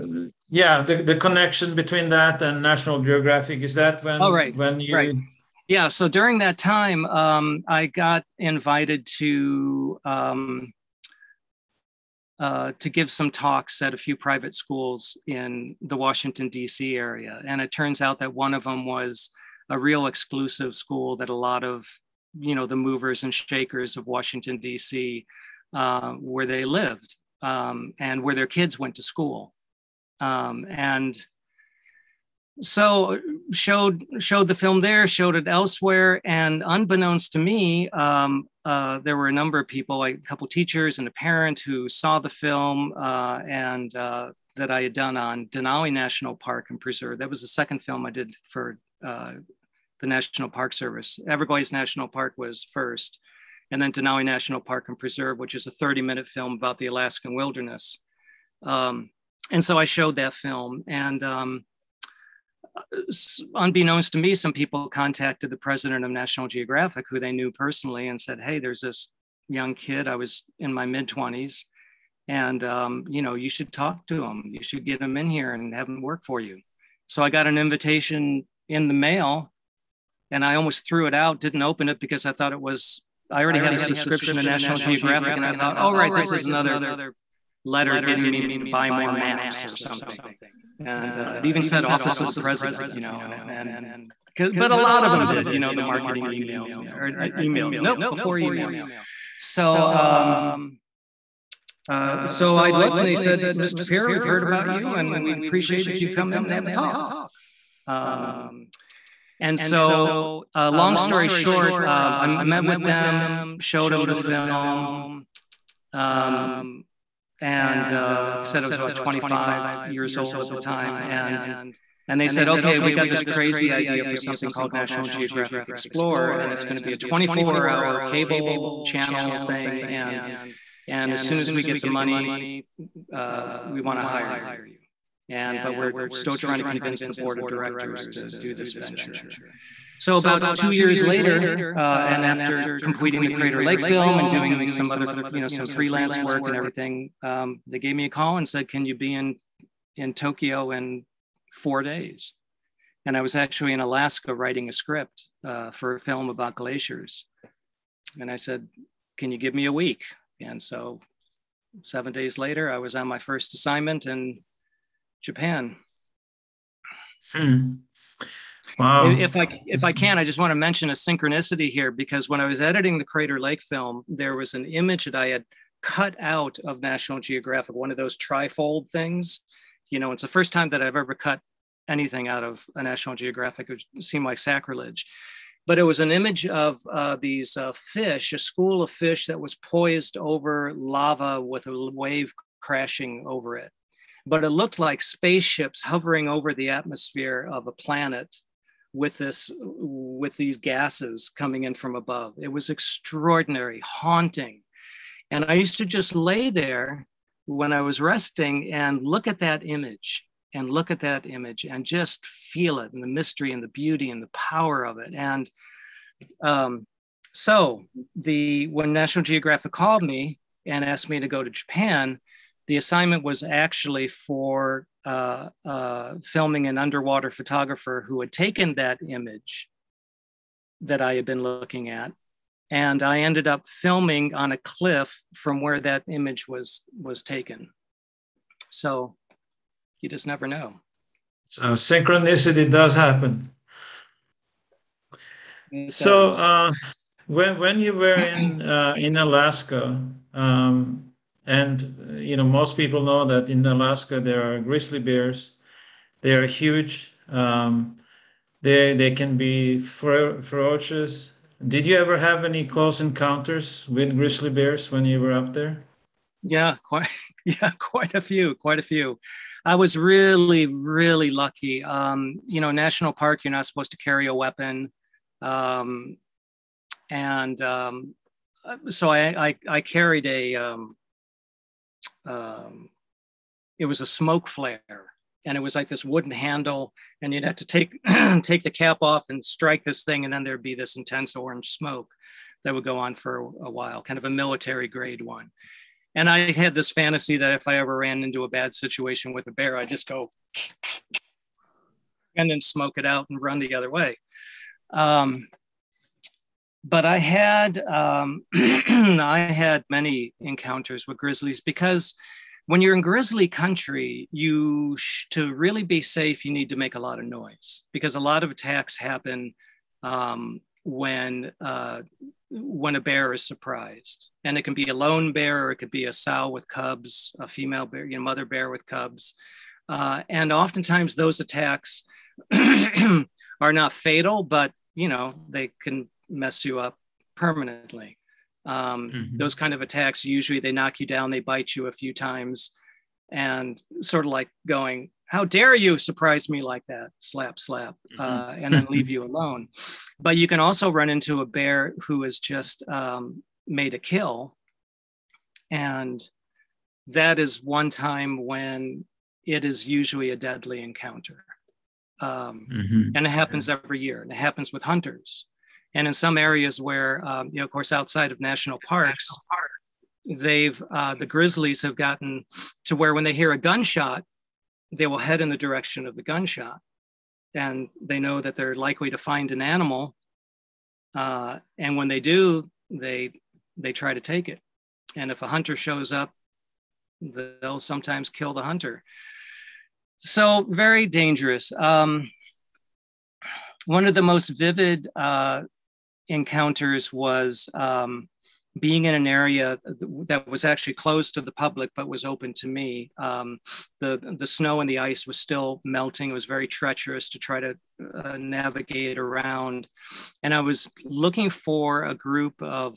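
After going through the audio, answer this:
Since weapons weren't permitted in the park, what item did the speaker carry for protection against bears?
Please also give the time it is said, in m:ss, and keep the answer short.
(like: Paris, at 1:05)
A smoke flare, at 4:44.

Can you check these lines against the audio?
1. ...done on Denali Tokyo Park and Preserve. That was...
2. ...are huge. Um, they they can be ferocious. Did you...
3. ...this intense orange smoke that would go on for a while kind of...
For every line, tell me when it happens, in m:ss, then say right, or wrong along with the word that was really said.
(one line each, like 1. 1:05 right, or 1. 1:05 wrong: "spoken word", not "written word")
1. 0:44 wrong: "National", not "Tokyo"
2. 4:16 right
3. 4:50 right.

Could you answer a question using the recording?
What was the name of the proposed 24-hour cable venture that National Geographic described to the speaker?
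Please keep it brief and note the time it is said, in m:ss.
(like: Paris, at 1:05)
National Geographic Explorer, at 2:04.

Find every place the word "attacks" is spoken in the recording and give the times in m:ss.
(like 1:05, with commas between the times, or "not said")
5:18, 5:31, 5:39.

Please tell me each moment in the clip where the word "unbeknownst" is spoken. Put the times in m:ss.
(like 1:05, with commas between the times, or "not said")
0:36, 1:03.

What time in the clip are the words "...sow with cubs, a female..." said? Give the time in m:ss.
5:26.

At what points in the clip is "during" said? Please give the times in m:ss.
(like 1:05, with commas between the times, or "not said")
0:06.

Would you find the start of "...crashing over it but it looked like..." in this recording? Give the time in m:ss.
3:12.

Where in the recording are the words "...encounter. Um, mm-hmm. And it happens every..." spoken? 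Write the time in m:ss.
6:00.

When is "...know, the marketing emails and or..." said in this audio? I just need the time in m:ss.
1:35.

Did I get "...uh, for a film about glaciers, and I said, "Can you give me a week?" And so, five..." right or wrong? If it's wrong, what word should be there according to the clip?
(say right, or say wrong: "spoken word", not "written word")
wrong: "seven", not "five".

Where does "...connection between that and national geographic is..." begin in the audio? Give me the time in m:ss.
0:01.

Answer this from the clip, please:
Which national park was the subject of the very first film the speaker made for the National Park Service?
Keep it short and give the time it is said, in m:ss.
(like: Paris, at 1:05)
Everglades National Park, at 0:51.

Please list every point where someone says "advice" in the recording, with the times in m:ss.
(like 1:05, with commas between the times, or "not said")
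not said.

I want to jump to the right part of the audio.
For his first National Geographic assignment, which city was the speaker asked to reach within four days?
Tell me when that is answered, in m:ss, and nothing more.
2:30.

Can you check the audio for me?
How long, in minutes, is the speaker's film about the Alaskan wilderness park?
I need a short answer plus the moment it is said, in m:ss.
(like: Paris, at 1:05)
30, at 0:55.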